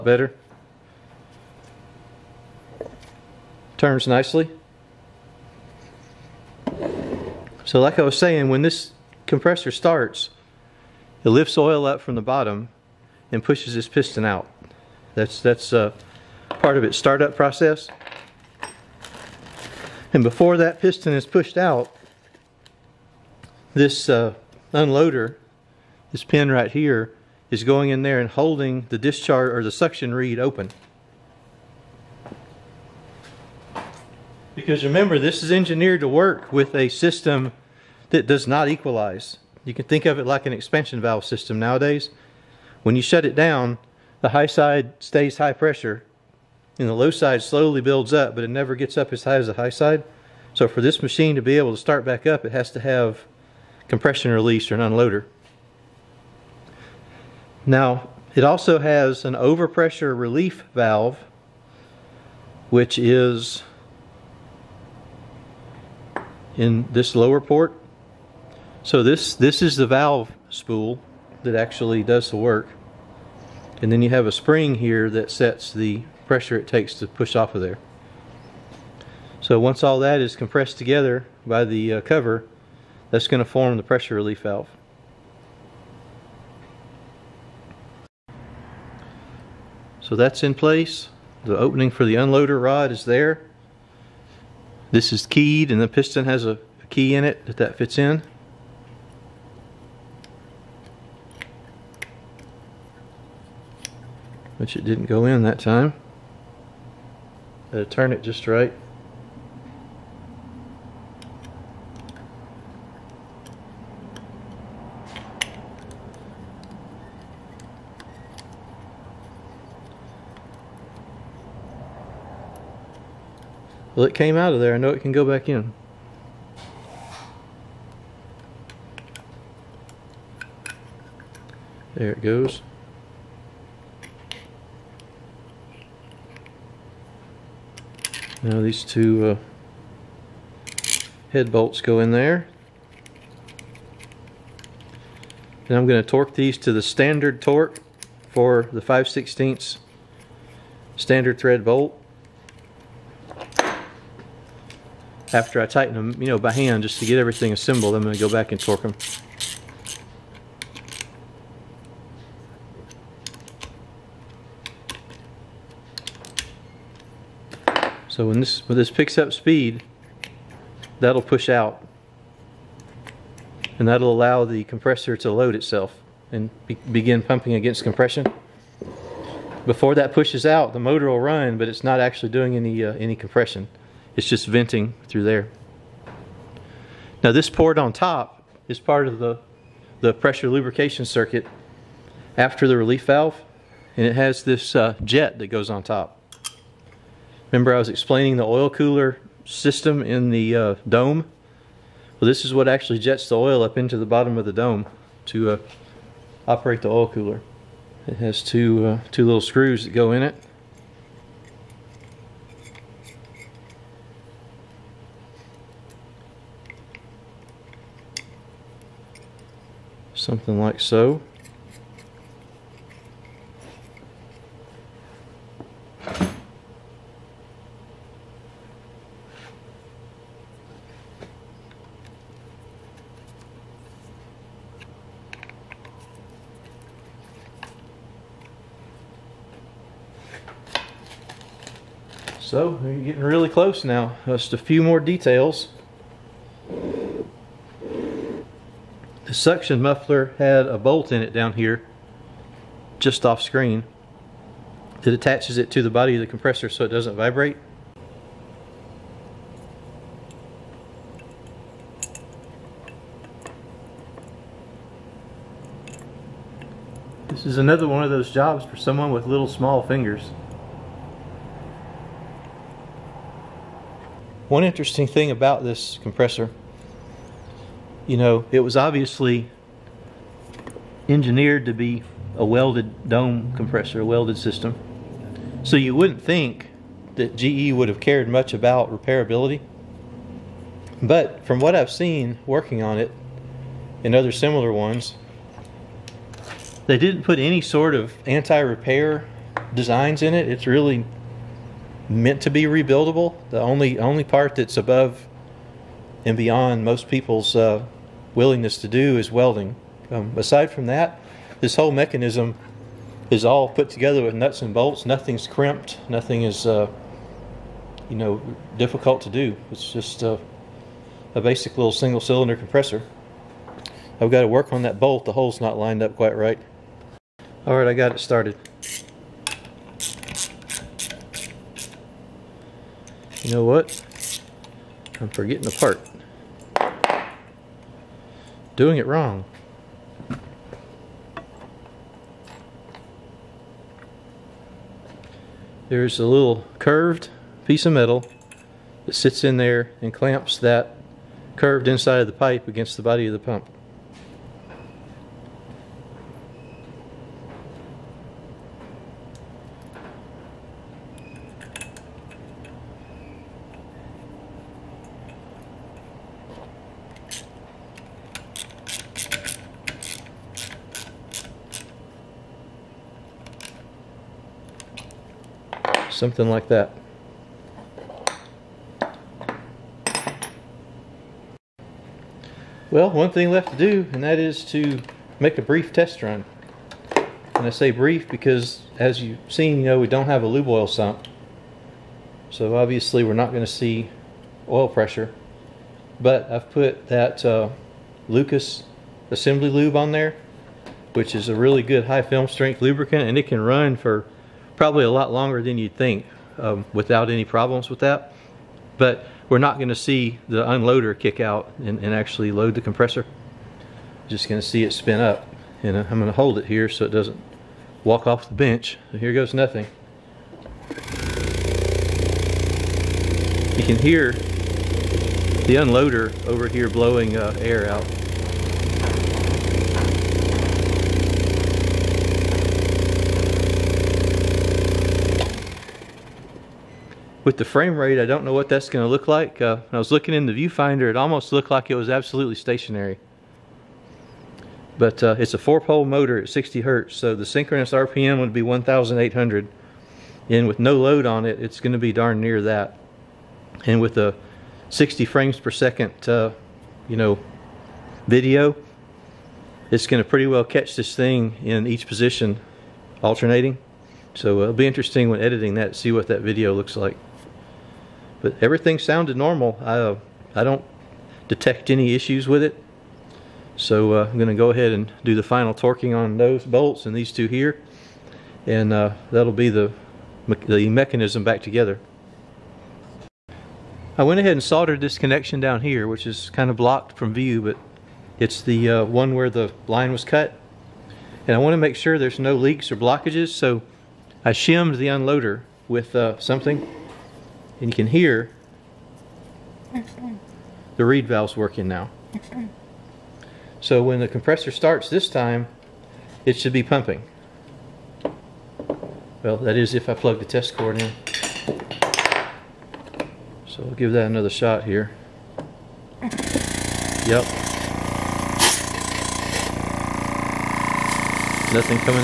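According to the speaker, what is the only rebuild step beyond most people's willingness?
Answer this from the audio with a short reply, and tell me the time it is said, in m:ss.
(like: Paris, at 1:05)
welding, at 5:09.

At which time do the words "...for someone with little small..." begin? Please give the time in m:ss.
4:28.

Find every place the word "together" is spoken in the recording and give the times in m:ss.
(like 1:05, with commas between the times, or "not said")
1:20, 5:13, 8:01.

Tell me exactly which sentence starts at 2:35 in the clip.
After I tighten them, you know, by hand, just to get everything assembled, I'm going to go back and torque them.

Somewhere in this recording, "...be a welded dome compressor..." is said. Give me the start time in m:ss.
4:41.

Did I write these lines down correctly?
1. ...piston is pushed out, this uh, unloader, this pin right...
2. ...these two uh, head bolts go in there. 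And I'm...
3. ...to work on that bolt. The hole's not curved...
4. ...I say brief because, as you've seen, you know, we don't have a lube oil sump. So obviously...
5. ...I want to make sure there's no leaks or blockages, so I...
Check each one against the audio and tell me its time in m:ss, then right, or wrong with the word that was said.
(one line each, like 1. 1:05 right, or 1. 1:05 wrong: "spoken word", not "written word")
1. 0:20 right
2. 2:18 right
3. 5:24 wrong: "lined", not "curved"
4. 6:27 right
5. 8:11 right.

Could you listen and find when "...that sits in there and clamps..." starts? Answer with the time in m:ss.
5:49.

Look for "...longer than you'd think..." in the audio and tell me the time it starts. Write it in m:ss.
6:45.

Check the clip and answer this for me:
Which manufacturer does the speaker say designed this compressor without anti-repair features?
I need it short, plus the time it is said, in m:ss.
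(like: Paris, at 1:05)
GE, at 4:47.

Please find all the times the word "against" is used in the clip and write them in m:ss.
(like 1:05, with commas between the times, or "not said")
2:57, 5:52.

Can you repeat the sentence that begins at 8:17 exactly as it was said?
And you can hear the reed valve's working now.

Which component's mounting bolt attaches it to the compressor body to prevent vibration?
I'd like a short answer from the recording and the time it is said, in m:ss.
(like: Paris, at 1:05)
suction muffler, at 4:09.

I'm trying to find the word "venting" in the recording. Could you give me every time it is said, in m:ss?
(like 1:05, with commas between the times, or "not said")
3:04.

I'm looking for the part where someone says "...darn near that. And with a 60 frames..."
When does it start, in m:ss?
7:32.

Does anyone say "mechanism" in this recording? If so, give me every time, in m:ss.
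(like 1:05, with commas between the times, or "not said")
5:11, 8:00.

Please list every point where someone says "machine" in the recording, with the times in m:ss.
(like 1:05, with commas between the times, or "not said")
0:51.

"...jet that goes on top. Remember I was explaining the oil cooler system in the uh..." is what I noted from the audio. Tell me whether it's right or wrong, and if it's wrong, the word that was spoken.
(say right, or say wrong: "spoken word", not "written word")
right.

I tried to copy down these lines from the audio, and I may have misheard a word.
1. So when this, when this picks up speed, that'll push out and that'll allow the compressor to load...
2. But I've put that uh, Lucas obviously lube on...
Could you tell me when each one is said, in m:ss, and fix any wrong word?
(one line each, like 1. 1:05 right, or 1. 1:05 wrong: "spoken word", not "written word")
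1. 2:48 right
2. 6:36 wrong: "assembly", not "obviously".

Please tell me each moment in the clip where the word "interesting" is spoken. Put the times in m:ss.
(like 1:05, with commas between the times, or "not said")
4:34, 7:44.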